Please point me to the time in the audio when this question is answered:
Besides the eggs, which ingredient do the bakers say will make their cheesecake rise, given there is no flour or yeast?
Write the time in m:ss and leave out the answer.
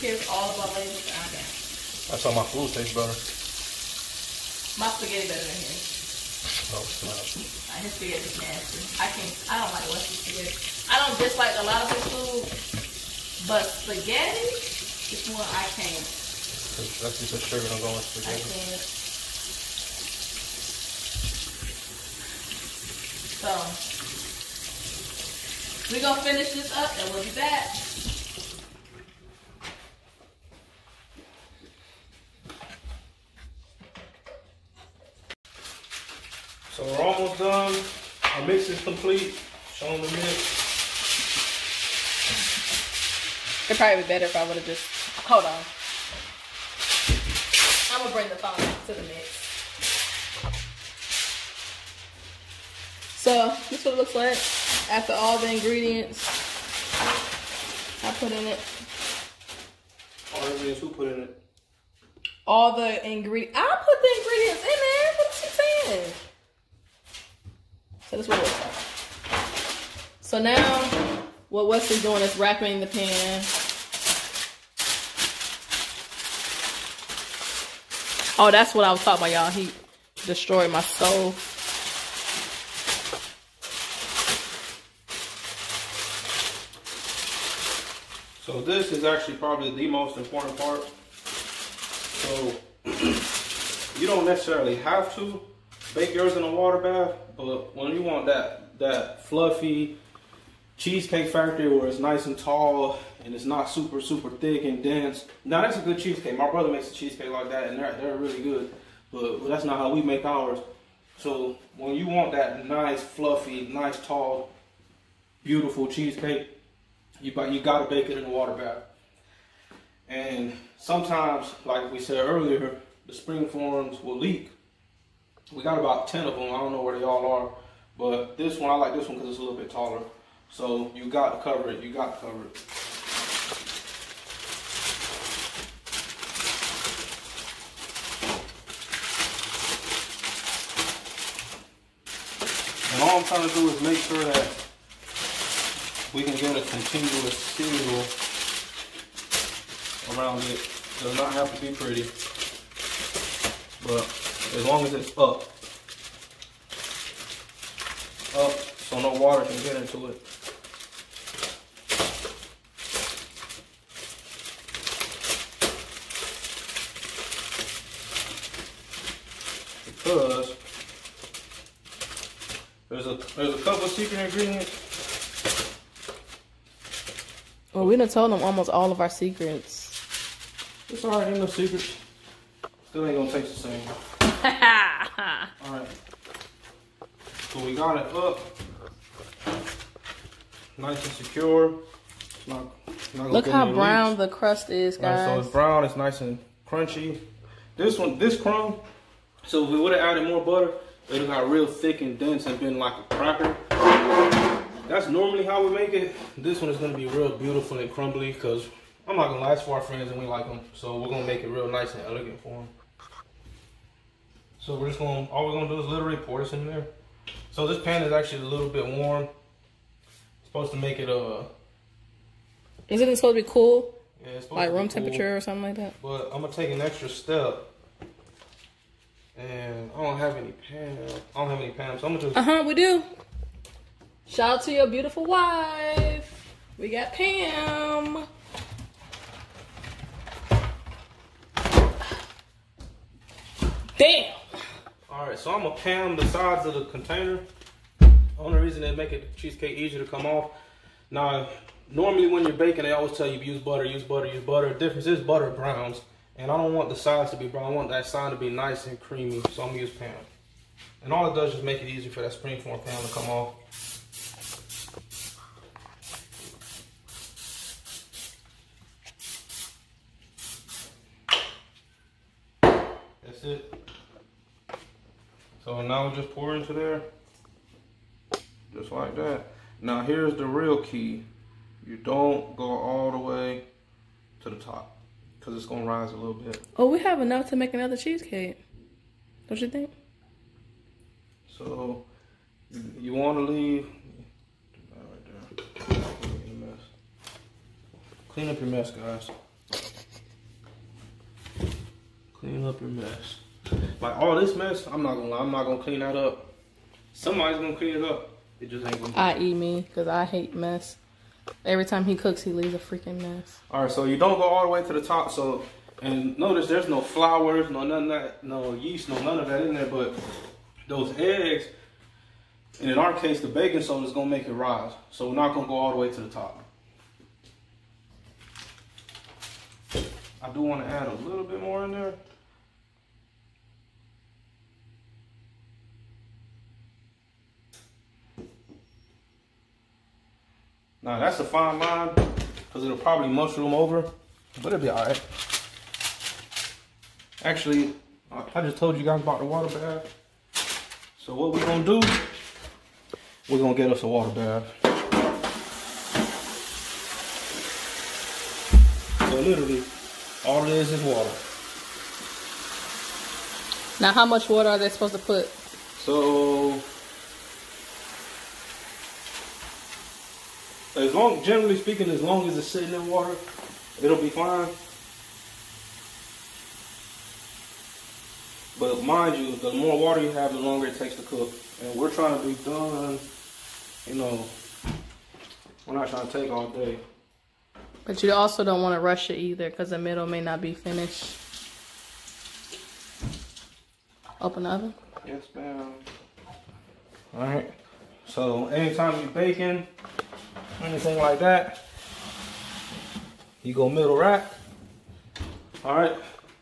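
5:23.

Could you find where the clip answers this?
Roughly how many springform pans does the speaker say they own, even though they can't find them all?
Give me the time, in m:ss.
2:05.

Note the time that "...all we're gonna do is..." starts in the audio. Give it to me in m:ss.
3:35.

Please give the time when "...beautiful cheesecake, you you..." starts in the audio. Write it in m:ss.
1:55.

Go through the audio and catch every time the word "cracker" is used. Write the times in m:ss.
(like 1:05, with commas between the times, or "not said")
3:23.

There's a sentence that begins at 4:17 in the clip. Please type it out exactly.
I want that side to be nice and creamy, so I'm gonna use Pam.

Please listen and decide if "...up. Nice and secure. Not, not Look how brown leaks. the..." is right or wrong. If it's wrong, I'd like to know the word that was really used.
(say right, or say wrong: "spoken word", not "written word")
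right.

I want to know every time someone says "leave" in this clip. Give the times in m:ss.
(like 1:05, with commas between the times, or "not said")
4:53, 5:12.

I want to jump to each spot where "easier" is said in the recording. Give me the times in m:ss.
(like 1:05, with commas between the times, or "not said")
4:09, 4:21.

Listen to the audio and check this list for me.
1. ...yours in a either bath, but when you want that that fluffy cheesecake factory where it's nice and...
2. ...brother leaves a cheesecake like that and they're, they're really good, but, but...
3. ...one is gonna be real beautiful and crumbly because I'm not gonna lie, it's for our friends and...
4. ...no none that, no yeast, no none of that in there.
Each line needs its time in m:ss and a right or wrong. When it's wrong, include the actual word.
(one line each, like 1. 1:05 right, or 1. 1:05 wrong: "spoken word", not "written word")
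1. 1:36 wrong: "water", not "either"
2. 1:46 wrong: "makes", not "leaves"
3. 3:26 right
4. 5:17 right.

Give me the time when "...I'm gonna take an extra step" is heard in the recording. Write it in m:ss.
3:46.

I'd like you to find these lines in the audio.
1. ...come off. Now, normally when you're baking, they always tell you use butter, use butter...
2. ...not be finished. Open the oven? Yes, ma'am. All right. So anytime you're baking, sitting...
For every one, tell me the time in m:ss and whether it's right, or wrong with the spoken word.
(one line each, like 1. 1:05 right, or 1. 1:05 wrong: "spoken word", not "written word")
1. 4:10 right
2. 6:30 wrong: "anything", not "sitting".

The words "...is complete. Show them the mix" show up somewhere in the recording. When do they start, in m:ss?
0:38.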